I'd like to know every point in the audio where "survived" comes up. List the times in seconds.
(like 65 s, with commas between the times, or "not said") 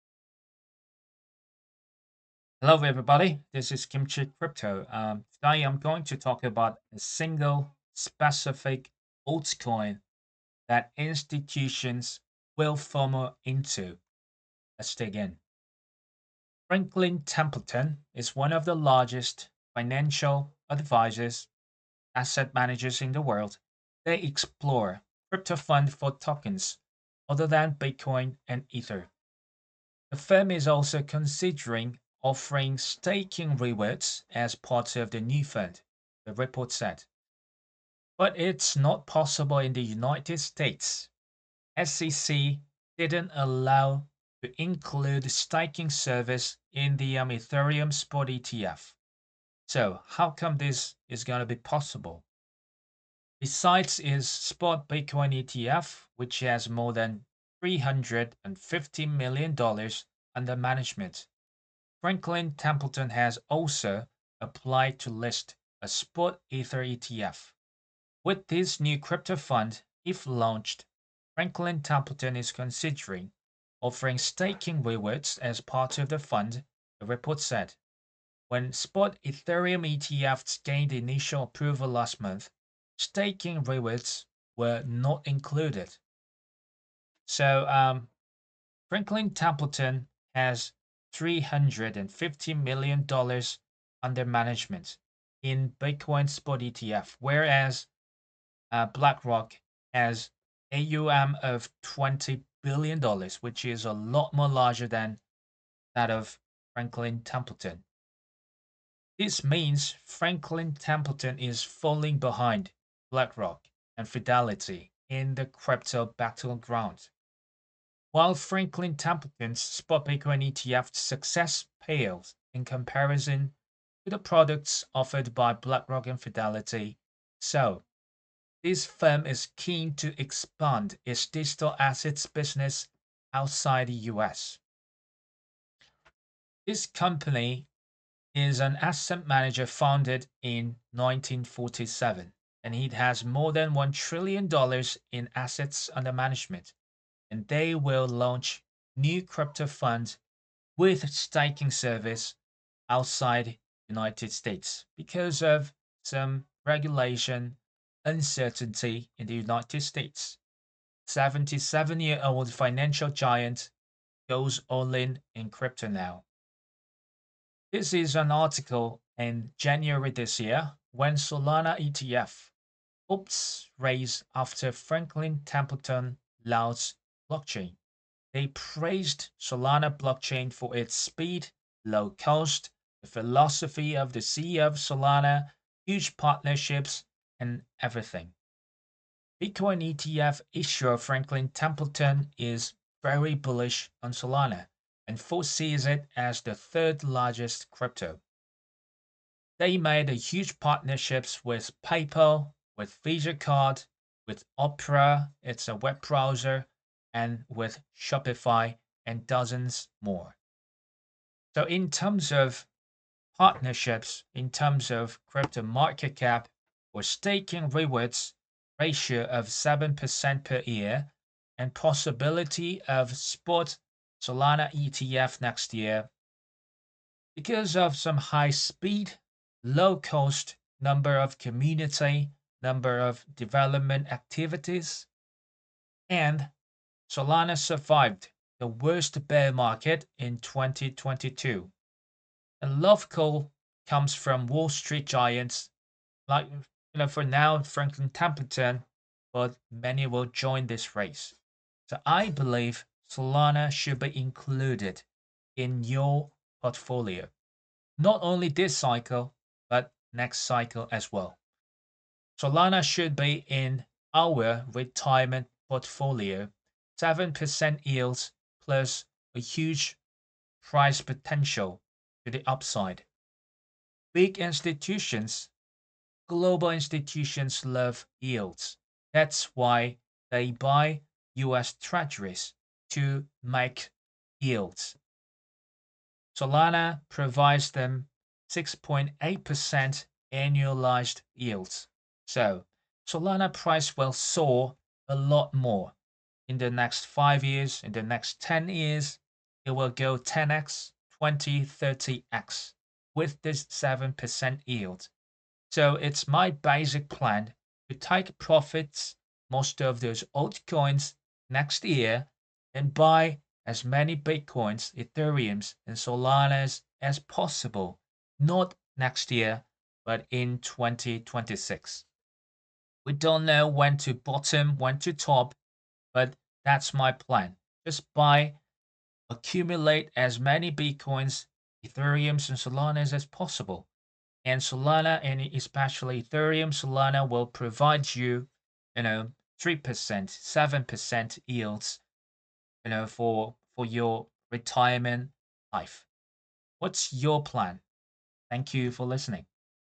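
237 s.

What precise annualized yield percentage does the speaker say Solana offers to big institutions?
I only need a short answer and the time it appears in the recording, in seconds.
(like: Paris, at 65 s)
6.8%, at 288 s.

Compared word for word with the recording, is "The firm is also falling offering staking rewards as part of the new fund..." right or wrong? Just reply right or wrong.
wrong.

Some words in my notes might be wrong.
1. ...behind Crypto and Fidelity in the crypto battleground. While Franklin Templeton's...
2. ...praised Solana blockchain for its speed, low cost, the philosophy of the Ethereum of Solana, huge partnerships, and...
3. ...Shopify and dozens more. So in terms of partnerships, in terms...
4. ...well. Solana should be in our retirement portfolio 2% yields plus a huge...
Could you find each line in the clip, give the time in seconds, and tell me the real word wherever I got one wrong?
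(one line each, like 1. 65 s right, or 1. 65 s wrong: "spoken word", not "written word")
1. 112 s wrong: "BlackRock", not "Crypto"
2. 178 s wrong: "CEO", not "Ethereum"
3. 207 s right
4. 261 s wrong: "7", not "2".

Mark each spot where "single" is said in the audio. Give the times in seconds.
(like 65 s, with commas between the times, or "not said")
6 s.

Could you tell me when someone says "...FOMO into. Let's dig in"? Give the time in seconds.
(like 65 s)
12 s.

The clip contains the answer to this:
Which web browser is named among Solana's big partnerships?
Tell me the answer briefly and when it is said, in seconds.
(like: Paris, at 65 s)
Opera, at 204 s.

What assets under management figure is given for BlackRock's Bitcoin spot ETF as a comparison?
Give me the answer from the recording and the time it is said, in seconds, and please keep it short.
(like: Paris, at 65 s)
$20 billion, at 101 s.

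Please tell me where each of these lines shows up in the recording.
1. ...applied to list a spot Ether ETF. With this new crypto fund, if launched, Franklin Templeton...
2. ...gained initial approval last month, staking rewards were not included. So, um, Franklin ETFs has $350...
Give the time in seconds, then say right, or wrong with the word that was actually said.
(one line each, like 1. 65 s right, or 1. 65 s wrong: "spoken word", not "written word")
1. 64 s right
2. 80 s wrong: "Templeton", not "ETFs".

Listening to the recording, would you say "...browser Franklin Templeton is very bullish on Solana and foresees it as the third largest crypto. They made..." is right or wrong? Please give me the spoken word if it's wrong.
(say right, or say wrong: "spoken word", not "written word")
wrong: "issuer", not "browser".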